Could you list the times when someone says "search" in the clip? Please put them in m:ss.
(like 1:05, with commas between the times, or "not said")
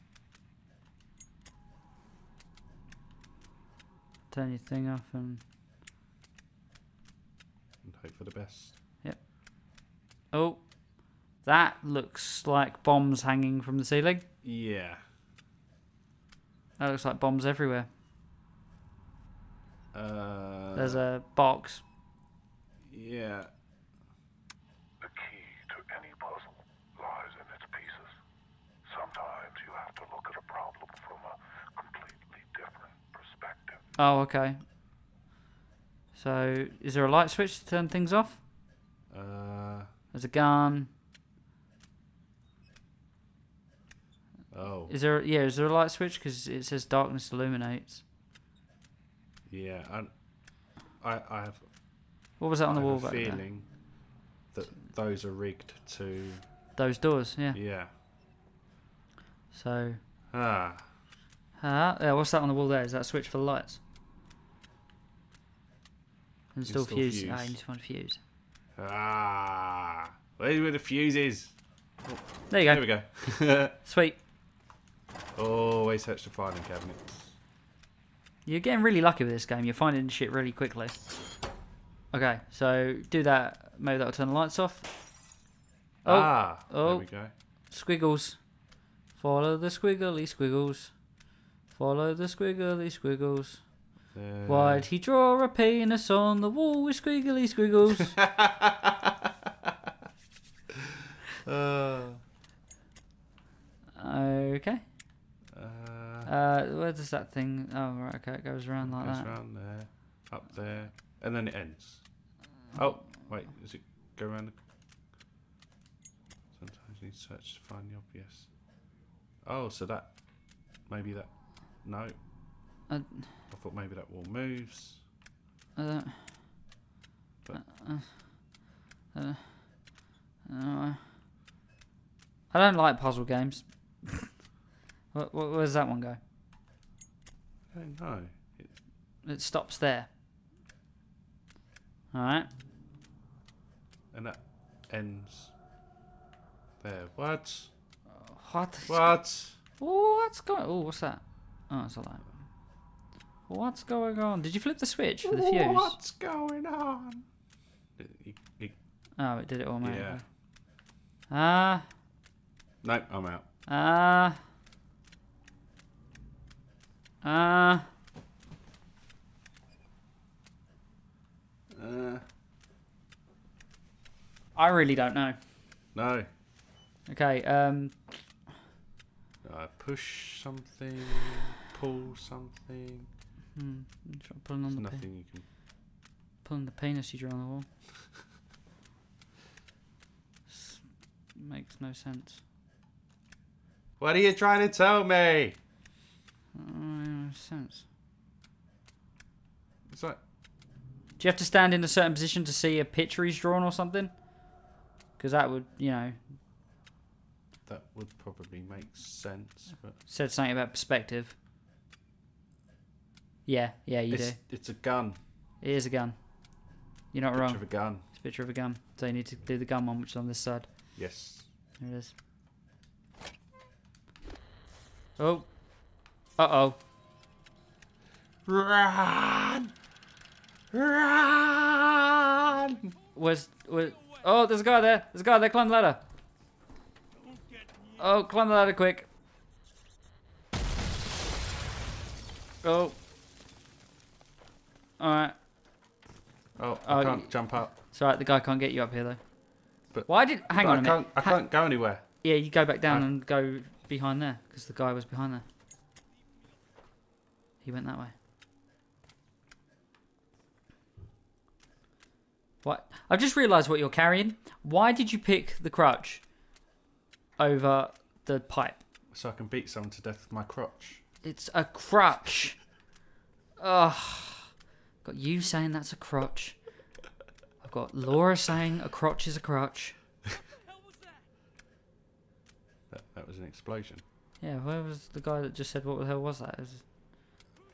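1:16, 1:57.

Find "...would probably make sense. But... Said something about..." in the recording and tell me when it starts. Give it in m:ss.
3:27.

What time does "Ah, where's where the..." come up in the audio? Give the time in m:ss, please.
1:08.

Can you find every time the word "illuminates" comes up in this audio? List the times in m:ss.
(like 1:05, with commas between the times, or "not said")
0:47.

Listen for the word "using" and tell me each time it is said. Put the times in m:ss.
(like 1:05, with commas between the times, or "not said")
not said.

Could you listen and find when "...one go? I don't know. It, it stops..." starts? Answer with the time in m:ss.
2:15.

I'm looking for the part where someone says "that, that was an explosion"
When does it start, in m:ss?
4:42.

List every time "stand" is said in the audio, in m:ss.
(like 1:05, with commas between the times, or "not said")
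3:21.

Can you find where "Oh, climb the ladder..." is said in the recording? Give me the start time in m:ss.
3:57.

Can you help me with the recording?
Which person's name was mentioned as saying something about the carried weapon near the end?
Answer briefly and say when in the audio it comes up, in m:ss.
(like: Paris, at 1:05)
Laura, at 4:37.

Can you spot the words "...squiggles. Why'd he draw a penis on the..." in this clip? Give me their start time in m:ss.
1:32.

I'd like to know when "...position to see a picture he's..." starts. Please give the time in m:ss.
3:22.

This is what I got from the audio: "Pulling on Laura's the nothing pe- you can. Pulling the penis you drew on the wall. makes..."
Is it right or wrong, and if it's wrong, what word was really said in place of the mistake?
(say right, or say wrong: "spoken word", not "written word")
wrong: "There", not "Laura".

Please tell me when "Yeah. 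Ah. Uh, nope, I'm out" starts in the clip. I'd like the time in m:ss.
2:39.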